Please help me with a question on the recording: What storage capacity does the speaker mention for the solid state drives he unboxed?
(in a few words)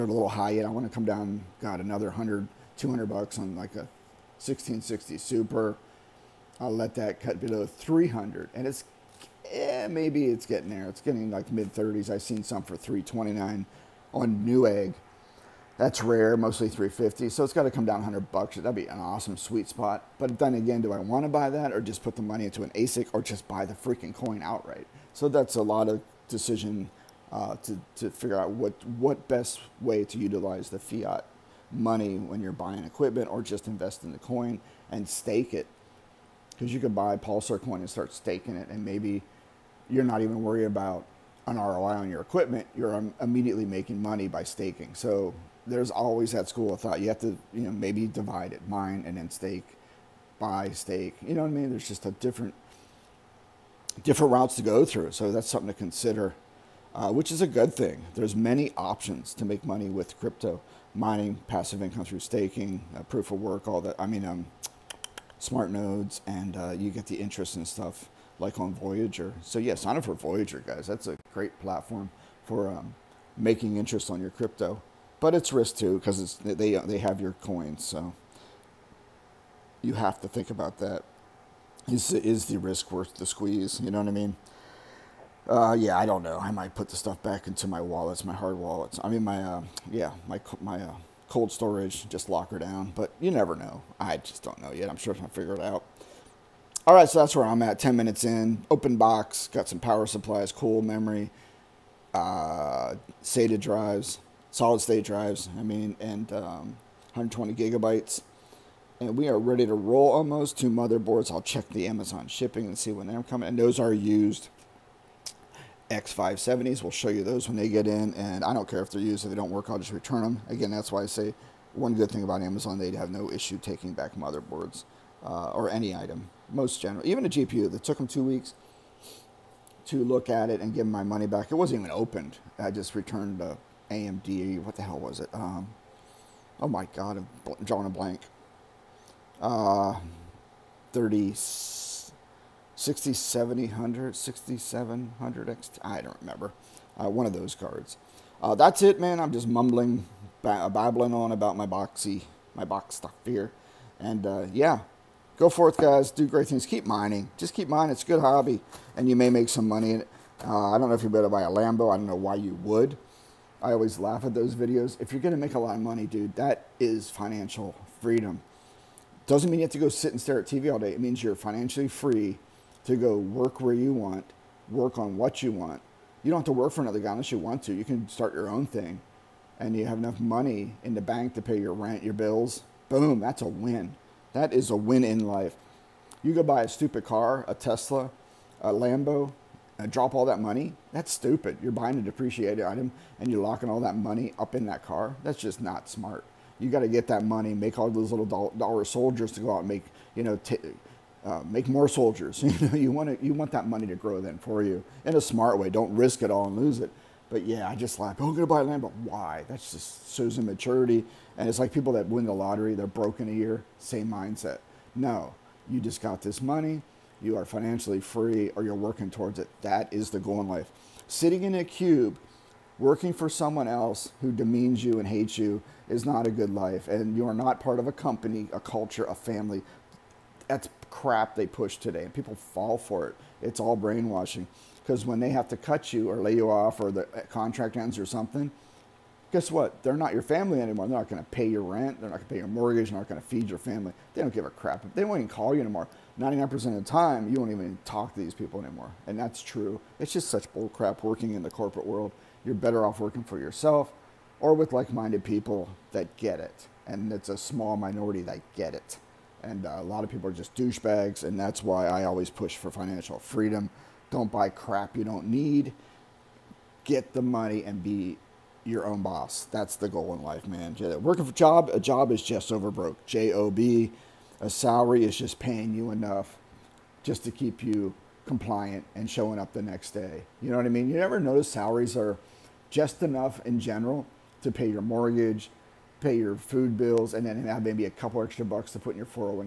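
120 gigabytes.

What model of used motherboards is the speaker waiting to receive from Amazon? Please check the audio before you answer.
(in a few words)
X570.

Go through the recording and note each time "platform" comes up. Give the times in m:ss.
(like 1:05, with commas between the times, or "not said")
1:11.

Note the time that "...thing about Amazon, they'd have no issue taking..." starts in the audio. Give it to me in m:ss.
2:02.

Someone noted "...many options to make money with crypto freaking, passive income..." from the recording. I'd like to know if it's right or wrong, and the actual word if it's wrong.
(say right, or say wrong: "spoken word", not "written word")
wrong: "mining", not "freaking".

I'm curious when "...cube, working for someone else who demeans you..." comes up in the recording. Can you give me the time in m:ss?
3:41.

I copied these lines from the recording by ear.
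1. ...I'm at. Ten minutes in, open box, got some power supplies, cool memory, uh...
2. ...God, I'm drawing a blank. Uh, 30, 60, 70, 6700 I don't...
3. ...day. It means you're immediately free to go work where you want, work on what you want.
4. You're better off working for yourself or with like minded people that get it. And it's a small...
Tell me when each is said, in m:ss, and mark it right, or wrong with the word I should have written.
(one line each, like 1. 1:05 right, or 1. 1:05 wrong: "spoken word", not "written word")
1. 1:37 right
2. 2:16 right
3. 2:50 wrong: "financially", not "immediately"
4. 4:12 right.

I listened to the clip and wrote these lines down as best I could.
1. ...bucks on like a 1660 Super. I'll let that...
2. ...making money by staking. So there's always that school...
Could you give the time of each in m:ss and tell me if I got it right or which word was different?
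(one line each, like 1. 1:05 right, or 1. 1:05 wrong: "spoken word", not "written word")
1. 0:03 right
2. 0:43 right.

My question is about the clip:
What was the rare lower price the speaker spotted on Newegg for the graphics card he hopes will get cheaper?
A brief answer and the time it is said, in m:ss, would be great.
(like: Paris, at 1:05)
$329, at 0:12.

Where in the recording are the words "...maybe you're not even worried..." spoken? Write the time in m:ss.
0:38.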